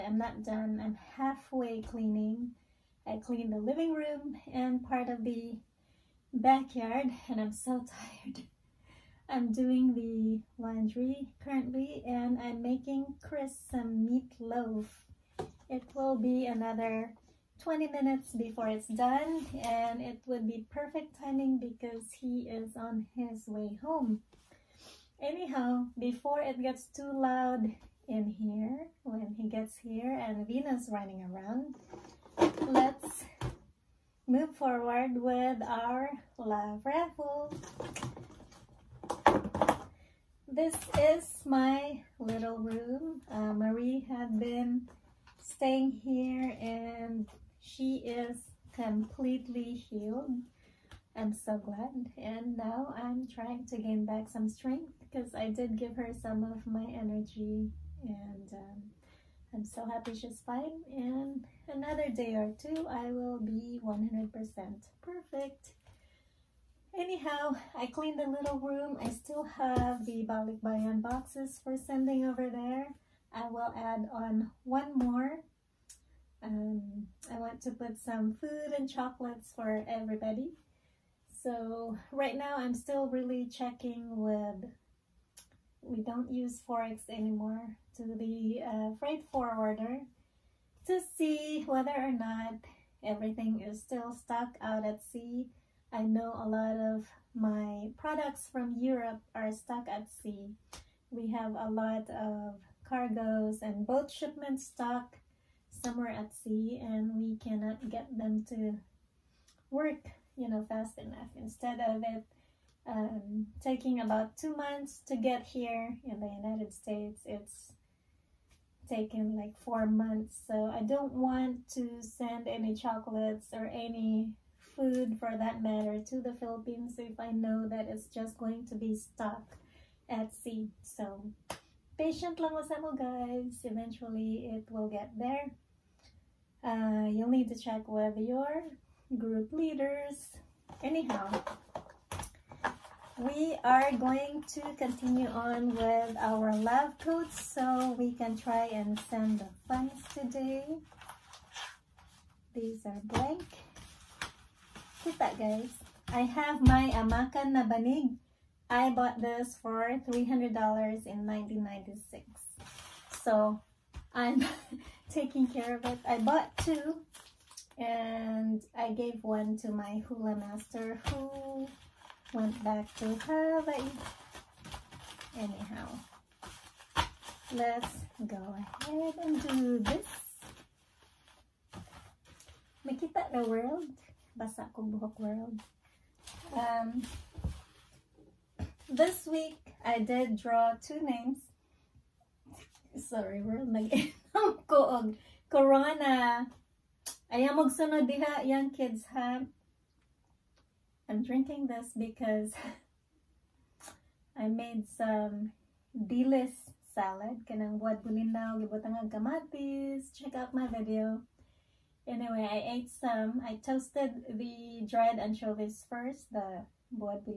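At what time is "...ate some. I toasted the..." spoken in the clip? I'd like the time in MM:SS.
03:32.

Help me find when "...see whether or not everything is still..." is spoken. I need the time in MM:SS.
01:31.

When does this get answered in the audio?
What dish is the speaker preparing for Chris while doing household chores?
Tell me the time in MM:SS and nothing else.
00:14.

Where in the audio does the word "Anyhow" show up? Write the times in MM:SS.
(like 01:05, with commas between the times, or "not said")
00:25, 01:06, 02:20, 02:55.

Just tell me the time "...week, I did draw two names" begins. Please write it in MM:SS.
03:09.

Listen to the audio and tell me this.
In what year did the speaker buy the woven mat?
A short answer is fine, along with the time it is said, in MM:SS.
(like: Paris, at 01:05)
1996, at 02:41.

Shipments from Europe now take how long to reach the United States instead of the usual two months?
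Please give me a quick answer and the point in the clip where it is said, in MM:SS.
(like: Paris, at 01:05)
4 months, at 01:59.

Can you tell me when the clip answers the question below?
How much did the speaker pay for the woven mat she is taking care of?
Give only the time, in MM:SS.
02:40.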